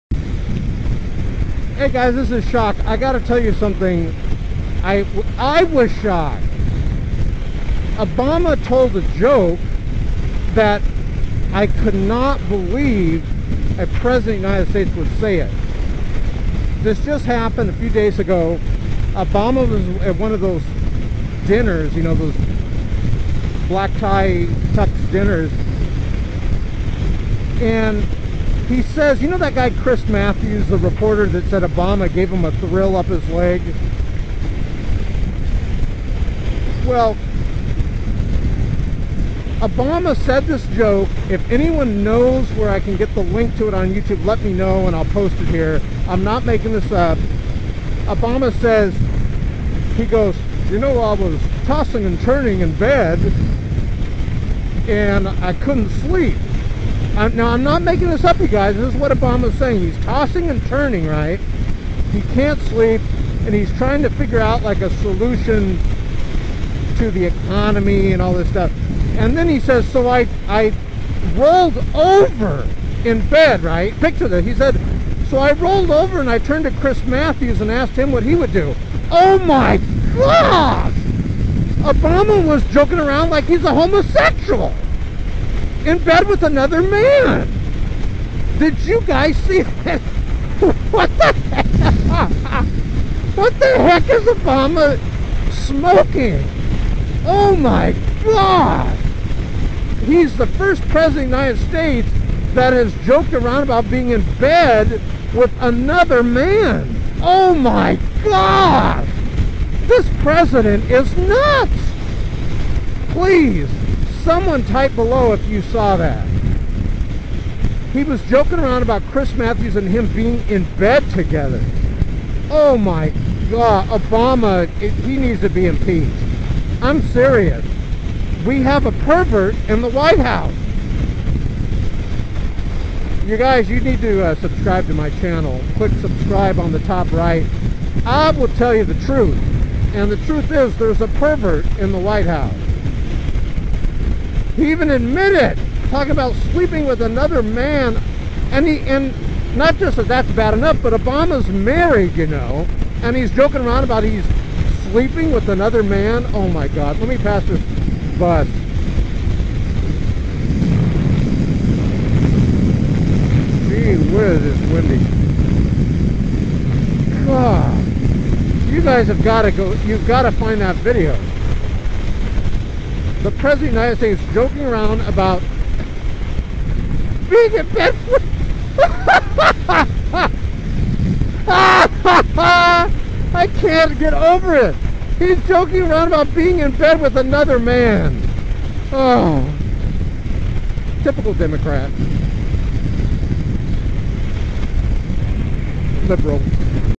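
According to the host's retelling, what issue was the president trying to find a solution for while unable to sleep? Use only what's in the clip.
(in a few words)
The economy.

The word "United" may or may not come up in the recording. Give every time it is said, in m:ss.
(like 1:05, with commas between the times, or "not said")
0:14, 1:41, 2:54.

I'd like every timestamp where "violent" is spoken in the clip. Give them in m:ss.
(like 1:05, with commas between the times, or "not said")
not said.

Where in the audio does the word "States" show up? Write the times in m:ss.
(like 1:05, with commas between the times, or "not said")
0:14, 1:41, 2:54.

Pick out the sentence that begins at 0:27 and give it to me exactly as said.
And he says, you know that guy Chris Matthews, the reporter that said Obama gave him a thrill up his leg?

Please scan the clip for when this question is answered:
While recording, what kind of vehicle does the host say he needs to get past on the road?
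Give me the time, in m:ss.
2:38.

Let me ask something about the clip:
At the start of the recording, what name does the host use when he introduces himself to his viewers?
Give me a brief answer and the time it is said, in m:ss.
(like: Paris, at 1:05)
Shock, at 0:02.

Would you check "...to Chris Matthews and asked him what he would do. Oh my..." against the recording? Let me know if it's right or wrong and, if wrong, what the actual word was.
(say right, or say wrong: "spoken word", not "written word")
right.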